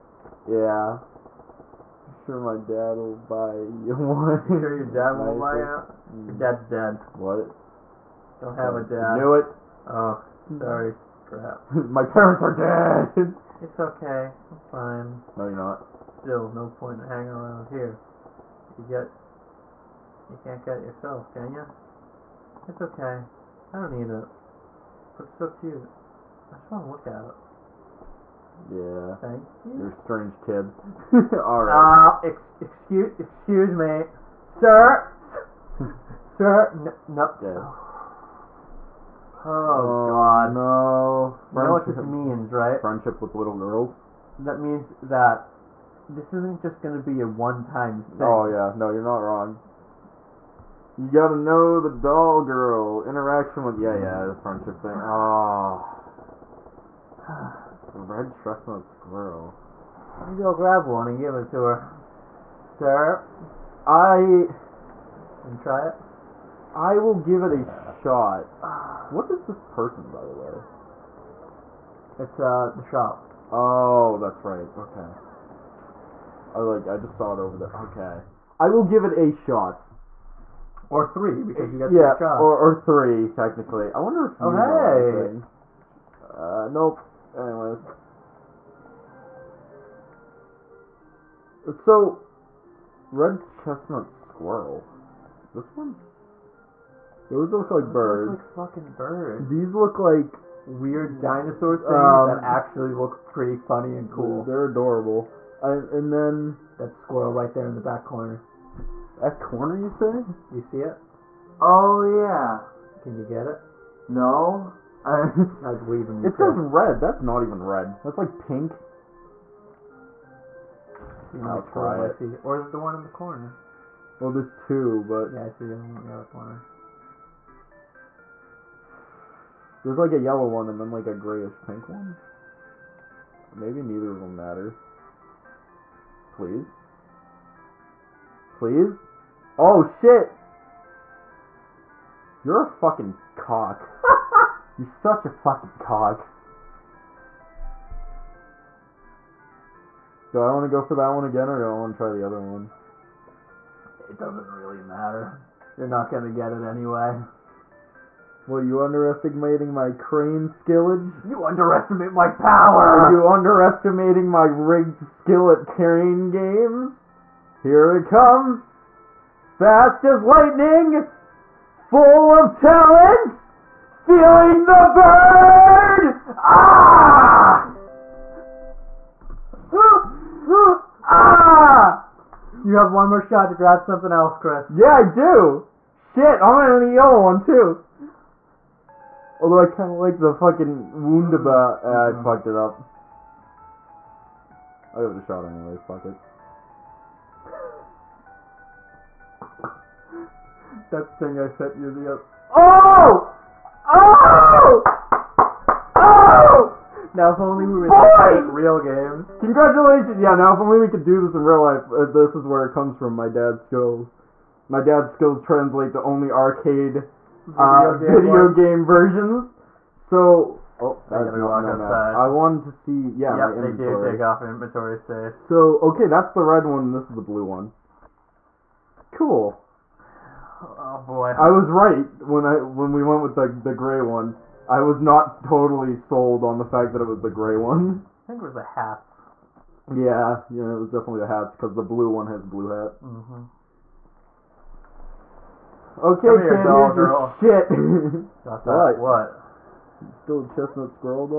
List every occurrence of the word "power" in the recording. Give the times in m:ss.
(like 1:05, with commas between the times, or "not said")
2:42.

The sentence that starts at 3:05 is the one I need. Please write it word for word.
Shit, I'm gonna need the yellow one too!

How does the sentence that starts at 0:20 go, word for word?
You can't get it yourself, can you?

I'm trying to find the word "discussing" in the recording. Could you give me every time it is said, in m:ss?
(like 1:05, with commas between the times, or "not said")
not said.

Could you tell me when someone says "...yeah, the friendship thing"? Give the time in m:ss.
0:53.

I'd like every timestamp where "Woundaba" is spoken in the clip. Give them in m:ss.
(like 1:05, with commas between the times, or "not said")
3:10.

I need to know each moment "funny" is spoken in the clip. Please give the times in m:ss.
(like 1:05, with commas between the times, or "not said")
1:43.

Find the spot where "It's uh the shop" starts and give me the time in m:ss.
1:12.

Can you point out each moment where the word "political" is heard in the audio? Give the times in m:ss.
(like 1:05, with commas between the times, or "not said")
not said.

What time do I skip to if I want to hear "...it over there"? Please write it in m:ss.
1:17.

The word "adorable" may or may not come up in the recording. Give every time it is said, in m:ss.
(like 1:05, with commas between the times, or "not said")
1:44.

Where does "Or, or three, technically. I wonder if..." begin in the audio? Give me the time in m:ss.
1:22.